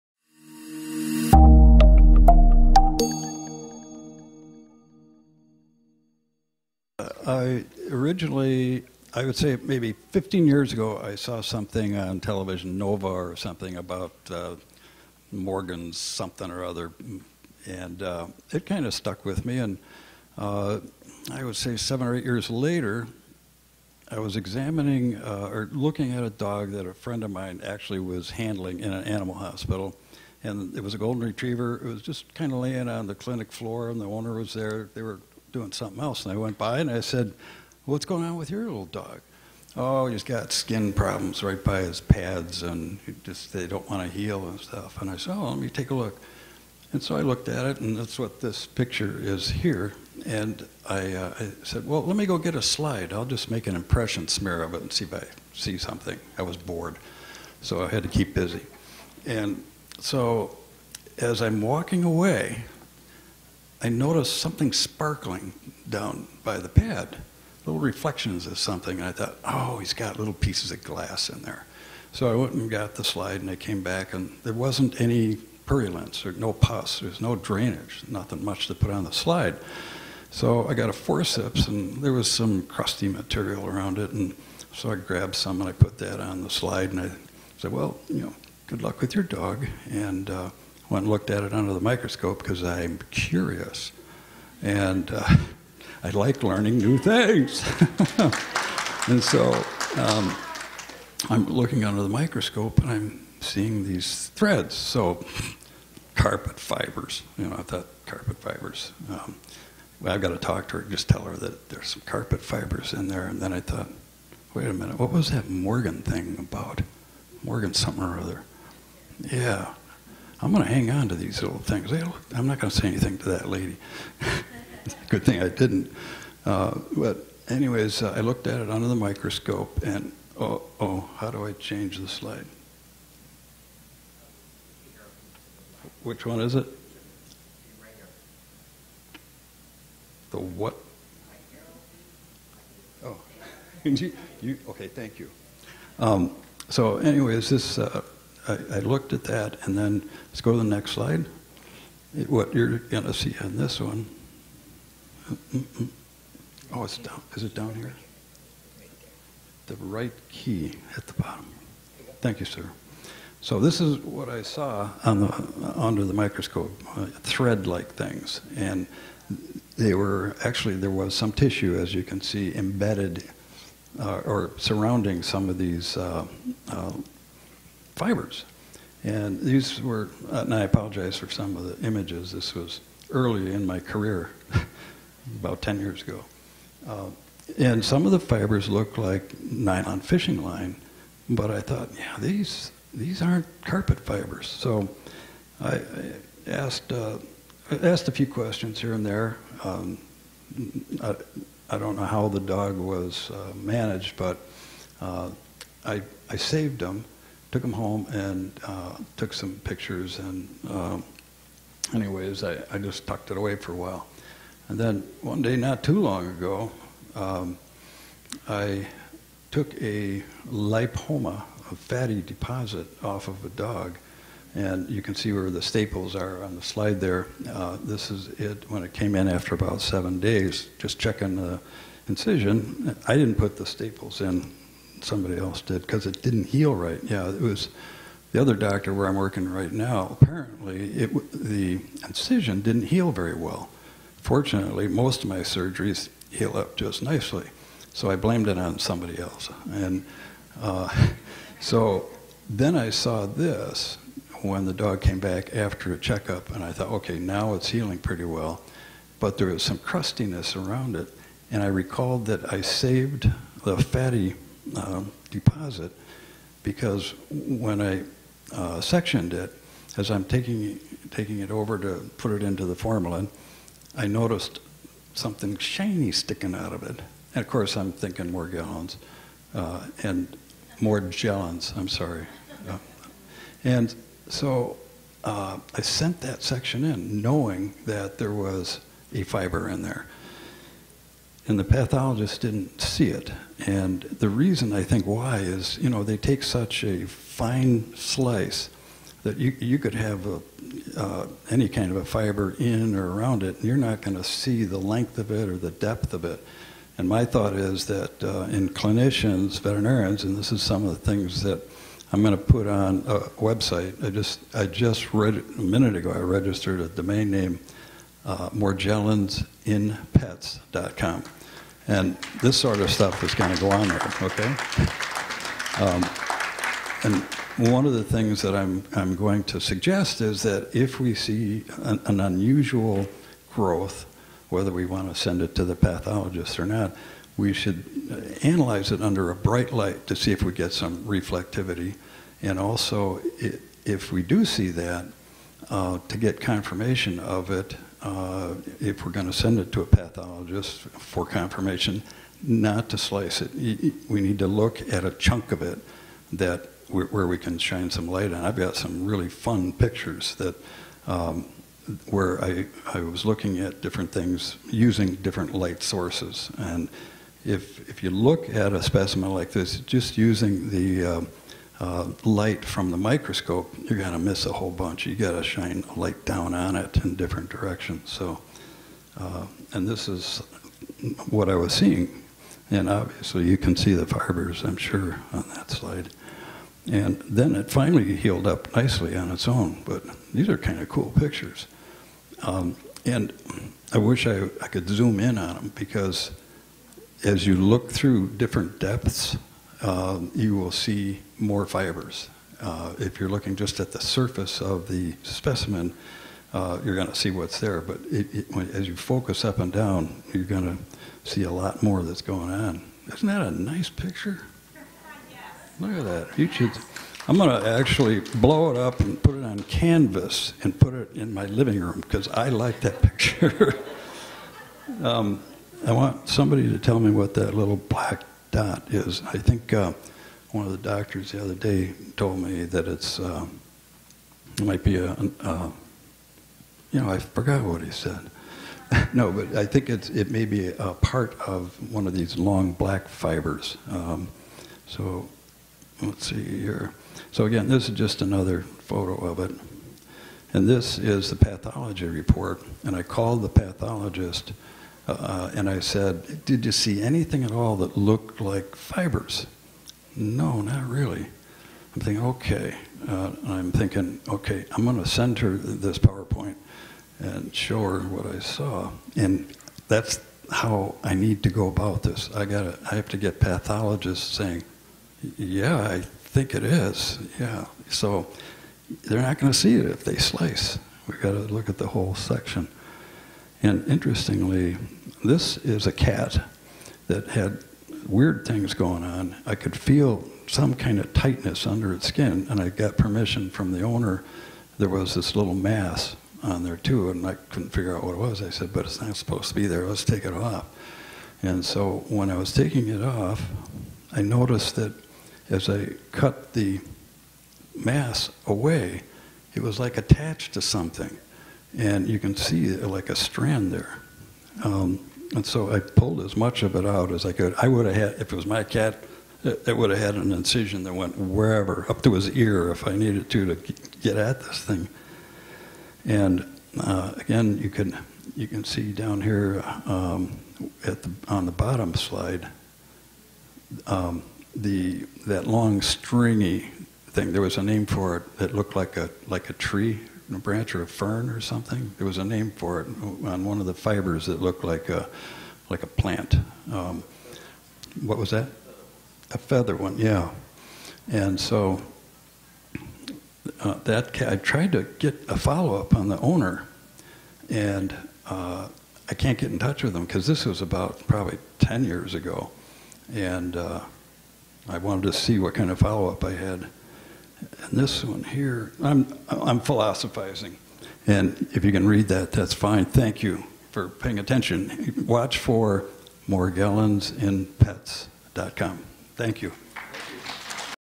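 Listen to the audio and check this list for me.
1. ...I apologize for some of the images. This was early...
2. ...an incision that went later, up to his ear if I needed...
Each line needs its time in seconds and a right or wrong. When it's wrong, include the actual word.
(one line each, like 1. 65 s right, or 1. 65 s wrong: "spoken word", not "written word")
1. 180 s right
2. 520 s wrong: "wherever", not "later".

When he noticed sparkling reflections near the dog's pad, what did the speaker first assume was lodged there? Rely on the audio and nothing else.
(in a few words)
Little pieces of glass.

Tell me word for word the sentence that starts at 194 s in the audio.
So I, I asked, uh, asked a few questions here and there.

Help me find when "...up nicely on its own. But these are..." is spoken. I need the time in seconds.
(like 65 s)
388 s.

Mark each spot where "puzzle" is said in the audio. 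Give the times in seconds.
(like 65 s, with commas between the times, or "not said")
not said.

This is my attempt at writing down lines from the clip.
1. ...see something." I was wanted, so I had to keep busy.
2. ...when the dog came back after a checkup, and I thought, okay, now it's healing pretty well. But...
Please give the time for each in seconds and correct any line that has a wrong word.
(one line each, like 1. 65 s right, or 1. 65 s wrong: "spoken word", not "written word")
1. 55 s wrong: "bored", not "wanted"
2. 254 s right.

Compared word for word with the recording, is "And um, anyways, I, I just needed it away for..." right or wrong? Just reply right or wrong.
wrong.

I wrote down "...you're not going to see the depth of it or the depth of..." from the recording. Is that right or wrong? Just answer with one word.
wrong.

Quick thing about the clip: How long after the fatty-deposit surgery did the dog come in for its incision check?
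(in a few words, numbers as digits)
7 days.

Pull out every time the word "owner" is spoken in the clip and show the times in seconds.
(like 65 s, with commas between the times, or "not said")
34 s, 493 s, 556 s.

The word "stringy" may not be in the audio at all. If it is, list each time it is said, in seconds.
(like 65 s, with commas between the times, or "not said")
535 s.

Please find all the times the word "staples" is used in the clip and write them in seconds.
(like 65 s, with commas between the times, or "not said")
225 s, 233 s.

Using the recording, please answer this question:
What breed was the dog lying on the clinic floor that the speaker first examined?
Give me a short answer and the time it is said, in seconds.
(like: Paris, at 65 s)
Golden retriever, at 30 s.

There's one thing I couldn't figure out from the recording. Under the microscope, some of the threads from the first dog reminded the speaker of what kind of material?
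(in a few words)
Nylon fishing line.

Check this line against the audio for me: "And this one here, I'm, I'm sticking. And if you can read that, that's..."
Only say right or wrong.
wrong.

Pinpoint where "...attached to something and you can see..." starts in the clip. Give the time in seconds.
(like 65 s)
509 s.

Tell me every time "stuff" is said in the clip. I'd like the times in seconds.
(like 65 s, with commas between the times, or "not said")
44 s, 322 s.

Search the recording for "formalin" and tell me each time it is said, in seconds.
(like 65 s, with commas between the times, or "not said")
272 s.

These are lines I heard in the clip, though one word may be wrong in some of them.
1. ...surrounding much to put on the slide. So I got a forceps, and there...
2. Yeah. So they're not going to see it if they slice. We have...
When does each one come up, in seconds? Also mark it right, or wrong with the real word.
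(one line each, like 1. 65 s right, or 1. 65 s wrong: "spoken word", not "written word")
1. 78 s wrong: "nothing", not "surrounding"
2. 477 s right.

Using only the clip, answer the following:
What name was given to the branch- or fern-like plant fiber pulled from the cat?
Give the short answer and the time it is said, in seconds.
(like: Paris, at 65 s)
Feather, at 549 s.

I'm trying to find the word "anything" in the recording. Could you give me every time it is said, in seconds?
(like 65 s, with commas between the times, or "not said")
122 s, 457 s.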